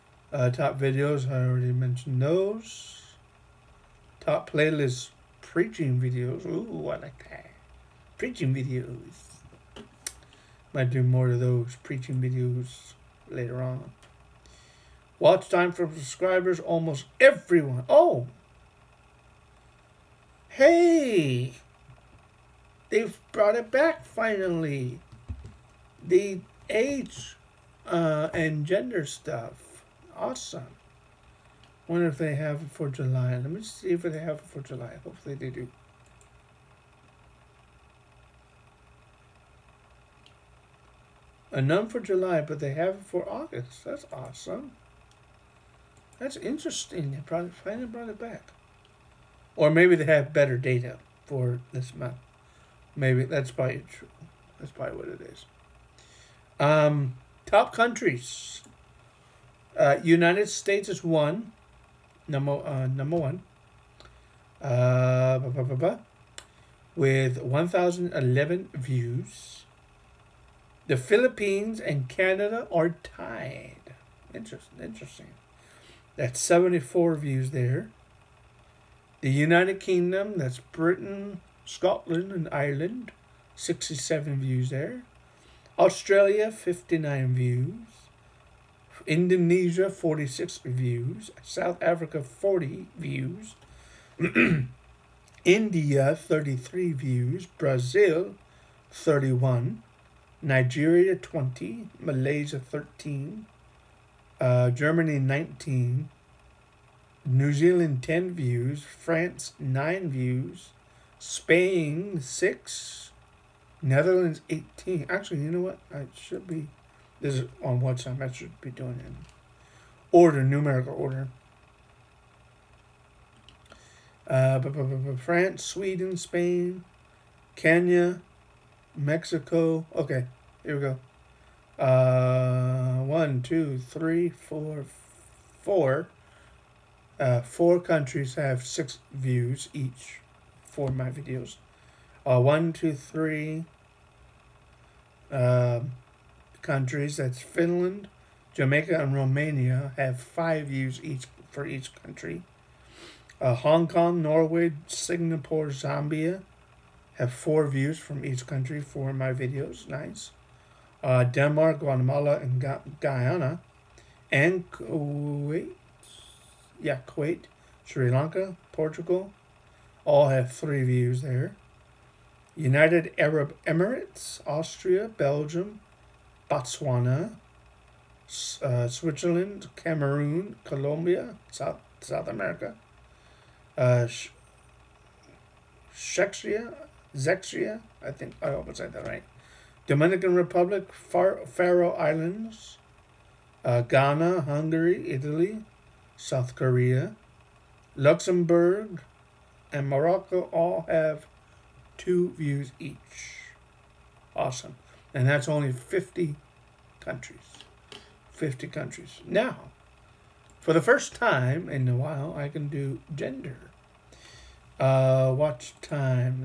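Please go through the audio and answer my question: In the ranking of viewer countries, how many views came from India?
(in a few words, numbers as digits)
33.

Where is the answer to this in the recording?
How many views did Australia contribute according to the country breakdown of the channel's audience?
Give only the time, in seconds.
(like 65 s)
86 s.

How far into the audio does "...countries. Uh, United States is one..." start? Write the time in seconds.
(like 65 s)
57 s.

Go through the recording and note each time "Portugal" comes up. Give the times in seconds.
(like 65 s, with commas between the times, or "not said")
168 s.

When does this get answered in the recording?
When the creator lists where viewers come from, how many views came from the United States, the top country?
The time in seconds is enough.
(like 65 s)
67 s.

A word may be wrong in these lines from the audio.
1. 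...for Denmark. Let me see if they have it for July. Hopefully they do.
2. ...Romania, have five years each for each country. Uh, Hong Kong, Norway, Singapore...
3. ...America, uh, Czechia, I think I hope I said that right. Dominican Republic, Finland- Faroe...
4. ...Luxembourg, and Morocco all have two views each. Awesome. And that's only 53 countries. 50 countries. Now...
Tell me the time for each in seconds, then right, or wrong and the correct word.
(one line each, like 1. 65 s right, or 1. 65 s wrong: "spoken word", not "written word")
1. 32 s wrong: "July", not "Denmark"
2. 149 s right
3. 182 s wrong: "Far", not "Finland"
4. 197 s wrong: "50", not "53".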